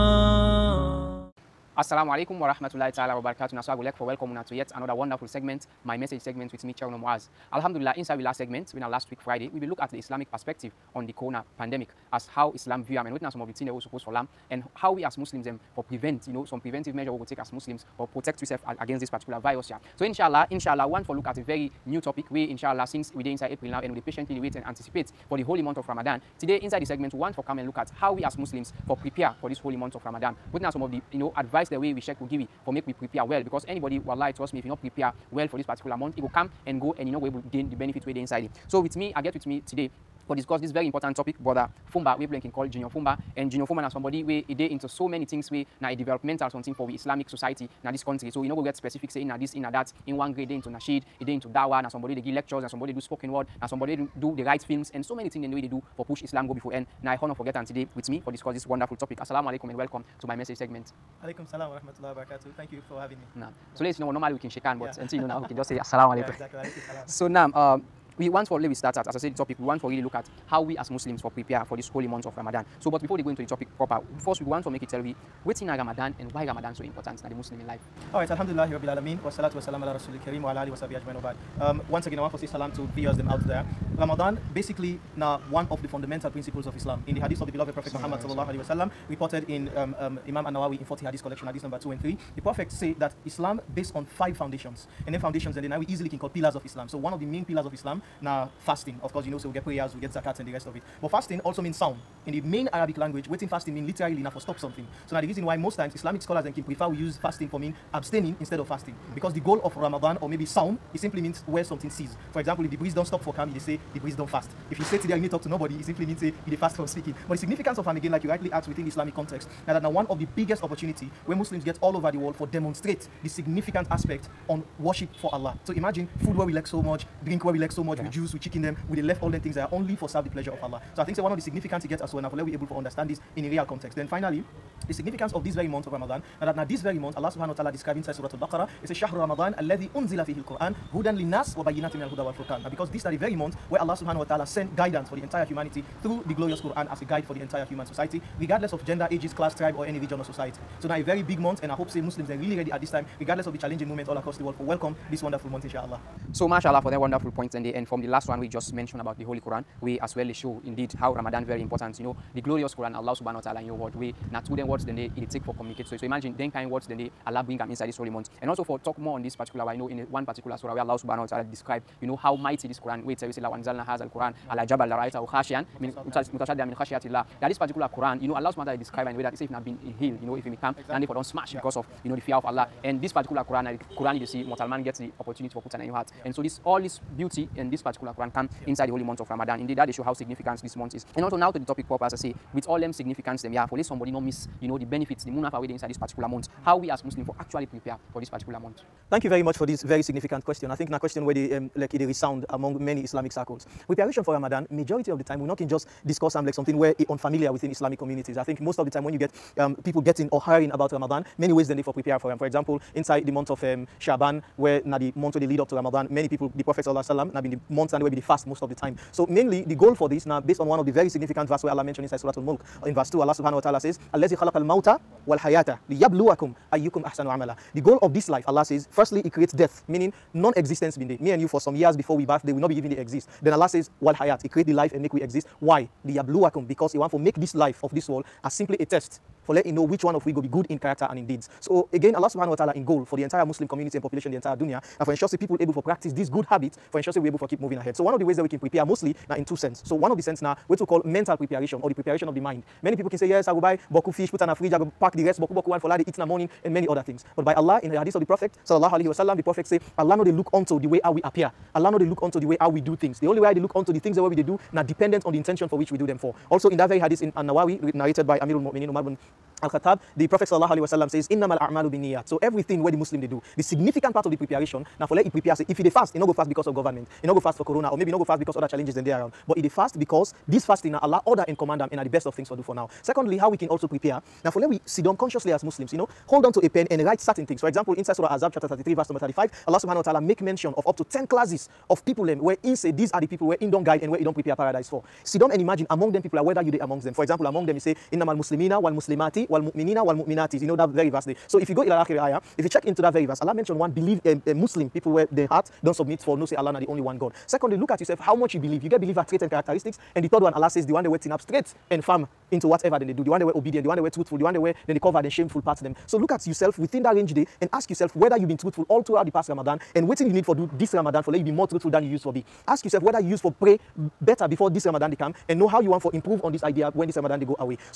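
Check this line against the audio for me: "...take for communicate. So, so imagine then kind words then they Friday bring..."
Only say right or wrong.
wrong.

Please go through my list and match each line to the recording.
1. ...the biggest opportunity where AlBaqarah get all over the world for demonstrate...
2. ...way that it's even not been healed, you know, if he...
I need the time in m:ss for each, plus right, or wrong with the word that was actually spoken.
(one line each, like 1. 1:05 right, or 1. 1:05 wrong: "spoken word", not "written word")
1. 2:00 wrong: "Muslims", not "AlBaqarah"
2. 2:59 right.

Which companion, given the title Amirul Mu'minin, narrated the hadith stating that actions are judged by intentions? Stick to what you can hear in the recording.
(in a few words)
Umar bin Al-Khattab.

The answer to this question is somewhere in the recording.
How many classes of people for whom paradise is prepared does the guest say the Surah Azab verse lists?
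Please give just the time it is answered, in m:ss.
4:51.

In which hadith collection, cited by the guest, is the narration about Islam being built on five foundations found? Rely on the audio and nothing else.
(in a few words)
Imam An-Nawawi 40 hadith.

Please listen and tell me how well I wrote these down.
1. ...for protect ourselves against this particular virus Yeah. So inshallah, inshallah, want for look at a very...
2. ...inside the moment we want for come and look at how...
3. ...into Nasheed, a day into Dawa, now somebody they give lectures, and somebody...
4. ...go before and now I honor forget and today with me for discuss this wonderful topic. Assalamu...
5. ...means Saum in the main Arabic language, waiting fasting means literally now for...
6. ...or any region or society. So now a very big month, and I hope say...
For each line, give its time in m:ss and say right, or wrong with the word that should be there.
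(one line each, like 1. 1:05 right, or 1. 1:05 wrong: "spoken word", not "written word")
1. 0:17 right
2. 0:26 wrong: "segment", not "moment"
3. 0:50 right
4. 0:56 right
5. 1:41 right
6. 2:29 right.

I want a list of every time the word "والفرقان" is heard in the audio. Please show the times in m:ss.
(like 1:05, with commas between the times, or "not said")
2:22.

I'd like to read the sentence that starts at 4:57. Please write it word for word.
For example, among them you say, Innamal Muslimina wal Muslimati wal Mu'minina wal Mu'minati.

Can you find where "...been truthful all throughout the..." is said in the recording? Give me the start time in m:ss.
5:18.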